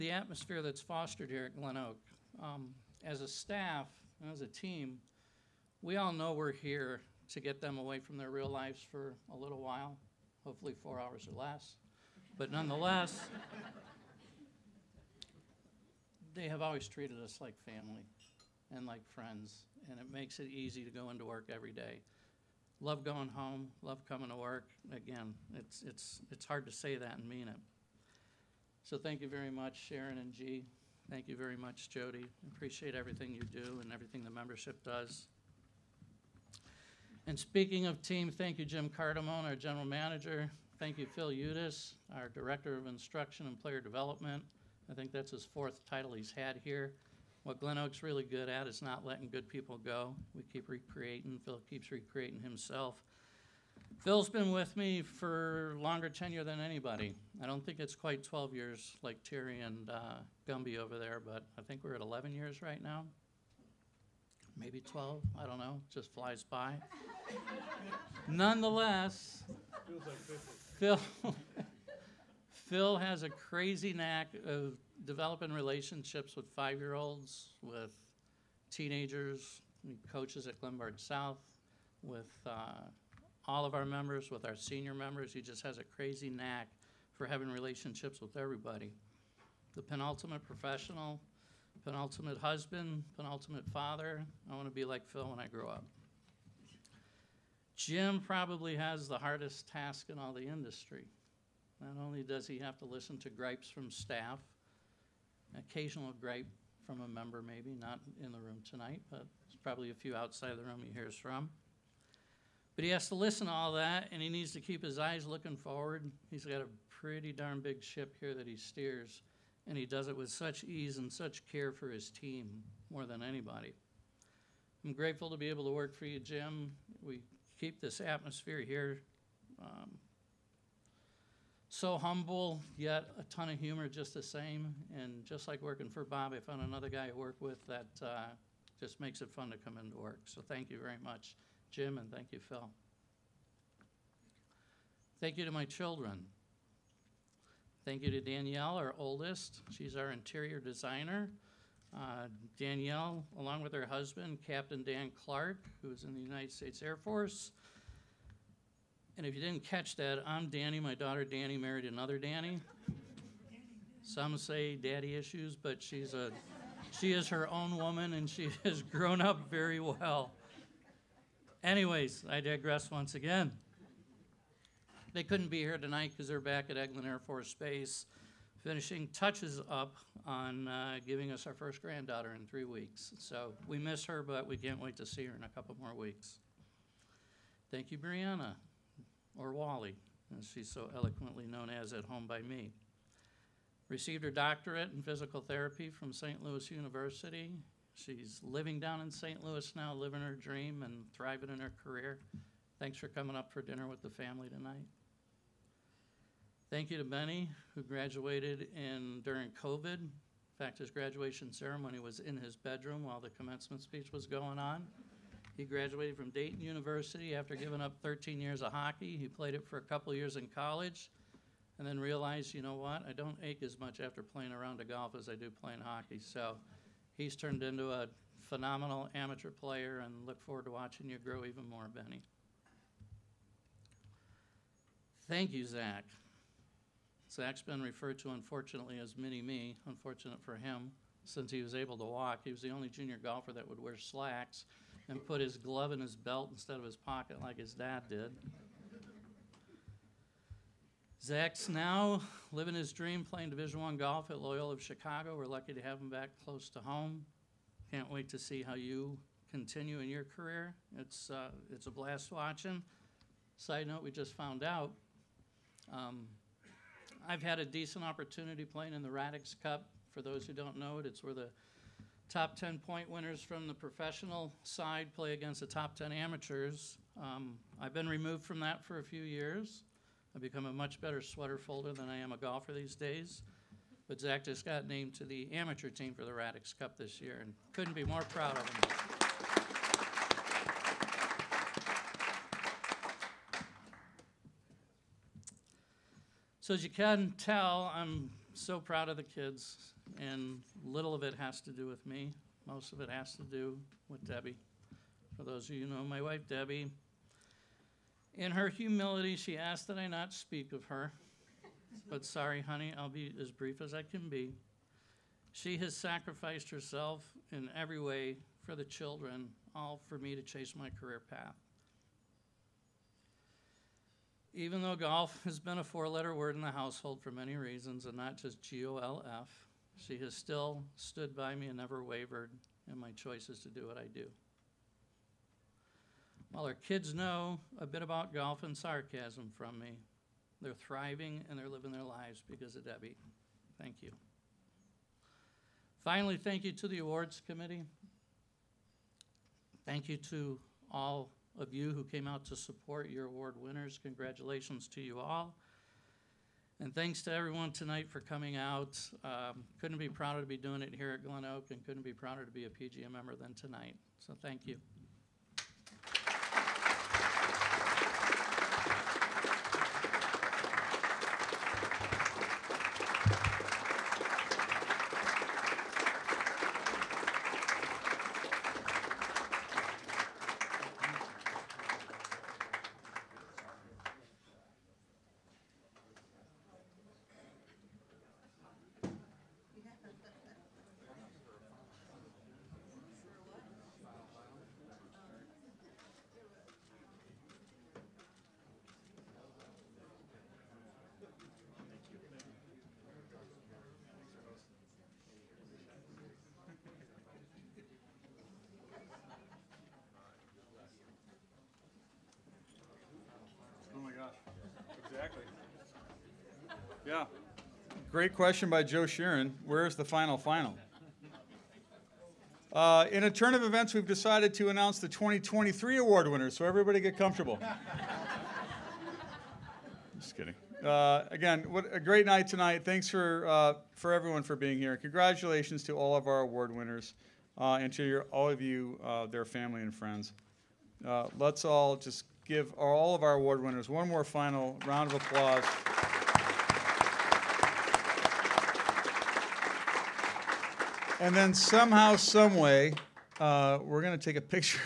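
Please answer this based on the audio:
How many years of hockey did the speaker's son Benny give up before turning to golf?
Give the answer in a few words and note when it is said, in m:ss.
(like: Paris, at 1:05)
13, at 3:38.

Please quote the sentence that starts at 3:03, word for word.
So we miss her, but we can't wait to see her in a couple more weeks.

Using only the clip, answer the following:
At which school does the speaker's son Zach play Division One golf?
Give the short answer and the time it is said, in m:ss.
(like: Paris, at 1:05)
Loyola of Chicago, at 4:14.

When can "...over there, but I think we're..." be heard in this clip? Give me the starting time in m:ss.
1:00.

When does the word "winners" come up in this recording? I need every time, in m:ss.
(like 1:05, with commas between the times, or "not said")
4:33, 5:53, 7:06, 7:16, 7:23.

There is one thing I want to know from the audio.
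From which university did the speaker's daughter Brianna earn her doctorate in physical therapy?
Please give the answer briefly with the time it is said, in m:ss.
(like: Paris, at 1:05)
St. Louis University, at 3:16.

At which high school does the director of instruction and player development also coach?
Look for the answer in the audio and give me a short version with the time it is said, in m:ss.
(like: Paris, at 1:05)
Glenbard South, at 1:20.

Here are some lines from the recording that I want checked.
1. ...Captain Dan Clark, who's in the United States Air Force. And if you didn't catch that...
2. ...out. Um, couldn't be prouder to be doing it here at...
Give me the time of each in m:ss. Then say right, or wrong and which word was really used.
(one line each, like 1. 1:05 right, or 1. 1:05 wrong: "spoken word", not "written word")
1. 2:34 right
2. 5:58 right.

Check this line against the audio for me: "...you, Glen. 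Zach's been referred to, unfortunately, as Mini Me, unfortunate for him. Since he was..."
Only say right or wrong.
wrong.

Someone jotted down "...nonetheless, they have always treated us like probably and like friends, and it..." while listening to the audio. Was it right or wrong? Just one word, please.
wrong.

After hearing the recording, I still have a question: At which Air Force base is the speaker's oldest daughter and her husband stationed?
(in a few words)
Eglin Air Force Base.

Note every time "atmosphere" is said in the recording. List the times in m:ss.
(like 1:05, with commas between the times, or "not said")
0:00, 2:07.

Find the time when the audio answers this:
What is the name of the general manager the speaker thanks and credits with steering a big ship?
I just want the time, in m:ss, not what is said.
0:38.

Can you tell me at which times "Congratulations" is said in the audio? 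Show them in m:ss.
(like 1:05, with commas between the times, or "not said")
5:54, 7:14.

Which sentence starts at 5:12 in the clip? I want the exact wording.
but sorry, honey, I'll be as brief as I can be.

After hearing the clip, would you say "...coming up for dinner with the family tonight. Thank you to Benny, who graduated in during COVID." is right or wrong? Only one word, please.
right.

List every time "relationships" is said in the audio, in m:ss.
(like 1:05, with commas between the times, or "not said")
1:15, 1:27.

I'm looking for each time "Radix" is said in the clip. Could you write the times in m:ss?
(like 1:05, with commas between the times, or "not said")
4:29, 4:46.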